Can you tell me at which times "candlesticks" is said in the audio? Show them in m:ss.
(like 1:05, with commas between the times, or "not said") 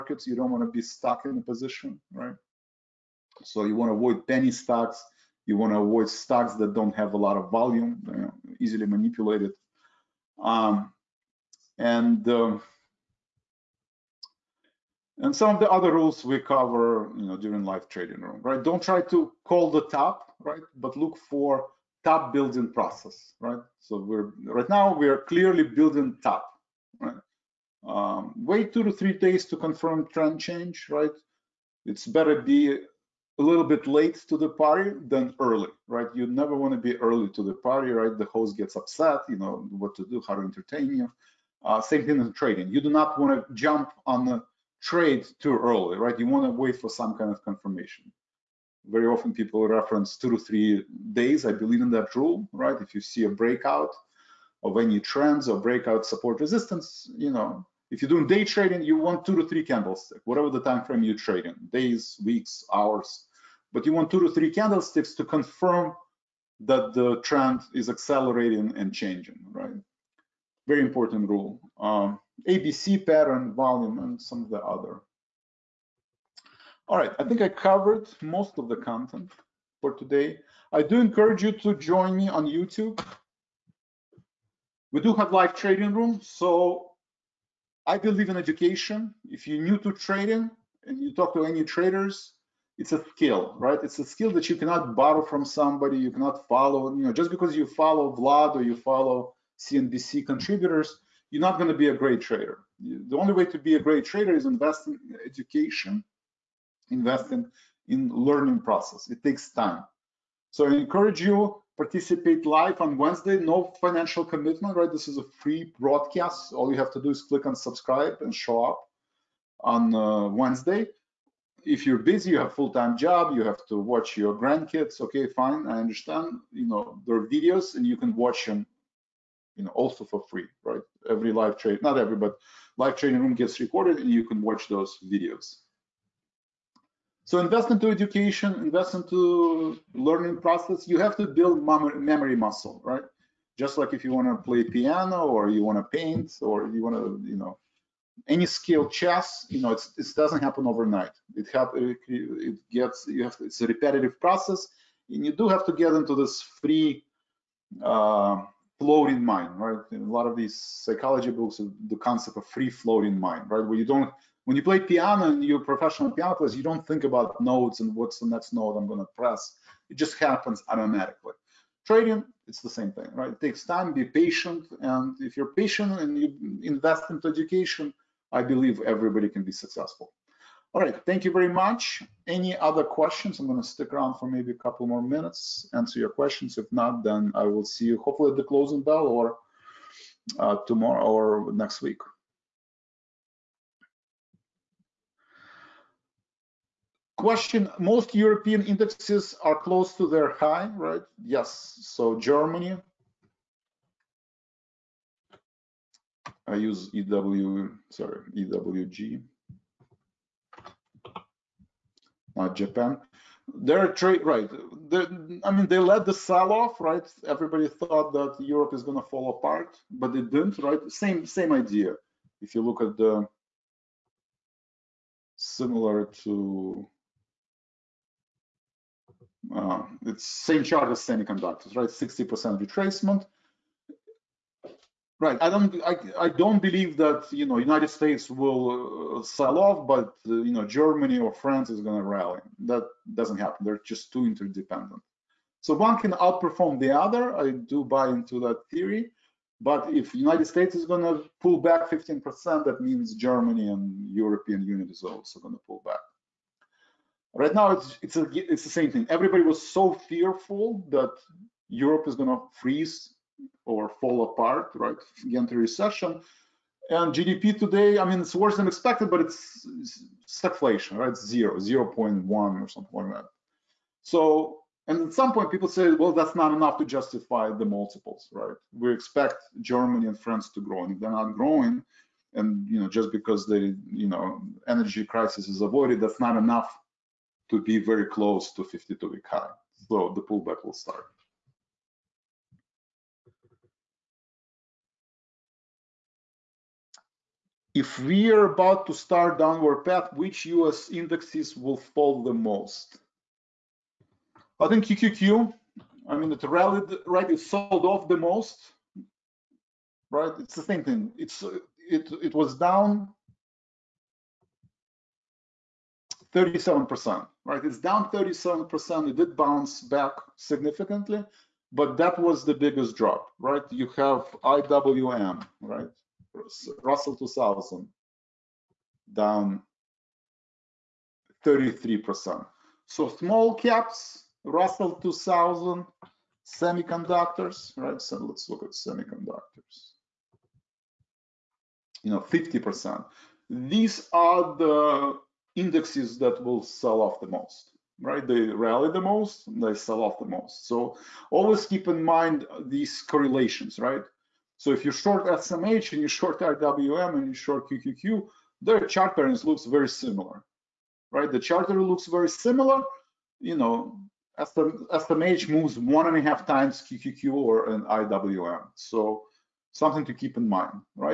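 0:59, 1:04.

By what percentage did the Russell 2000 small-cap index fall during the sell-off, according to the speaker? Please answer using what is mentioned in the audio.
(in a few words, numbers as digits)
33%.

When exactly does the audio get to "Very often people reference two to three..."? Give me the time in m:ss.
0:48.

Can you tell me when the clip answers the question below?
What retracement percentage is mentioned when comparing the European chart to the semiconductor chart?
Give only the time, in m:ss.
3:51.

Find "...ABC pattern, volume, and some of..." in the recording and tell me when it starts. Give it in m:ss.
1:12.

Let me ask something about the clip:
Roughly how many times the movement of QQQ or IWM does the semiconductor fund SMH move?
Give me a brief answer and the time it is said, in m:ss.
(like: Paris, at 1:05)
1.5 times, at 6:05.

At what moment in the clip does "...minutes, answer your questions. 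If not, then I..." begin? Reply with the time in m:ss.
3:05.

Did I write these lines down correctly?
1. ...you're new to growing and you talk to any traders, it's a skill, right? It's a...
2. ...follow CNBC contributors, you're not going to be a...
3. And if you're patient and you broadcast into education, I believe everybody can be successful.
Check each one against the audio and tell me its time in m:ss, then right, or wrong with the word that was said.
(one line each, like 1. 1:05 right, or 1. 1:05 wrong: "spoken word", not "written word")
1. 1:29 wrong: "trading", not "growing"
2. 1:38 right
3. 2:54 wrong: "invest", not "broadcast".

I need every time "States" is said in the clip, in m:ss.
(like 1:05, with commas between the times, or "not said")
3:57, 4:10.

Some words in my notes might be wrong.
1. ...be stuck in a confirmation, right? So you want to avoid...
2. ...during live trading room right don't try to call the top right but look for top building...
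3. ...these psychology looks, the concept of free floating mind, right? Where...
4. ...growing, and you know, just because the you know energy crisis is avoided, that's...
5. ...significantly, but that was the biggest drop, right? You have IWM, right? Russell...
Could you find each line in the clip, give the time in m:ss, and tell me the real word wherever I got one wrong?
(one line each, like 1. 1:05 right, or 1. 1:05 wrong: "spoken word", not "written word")
1. 0:00 wrong: "position", not "confirmation"
2. 0:17 right
3. 2:40 wrong: "books", not "looks"
4. 4:41 right
5. 5:20 right.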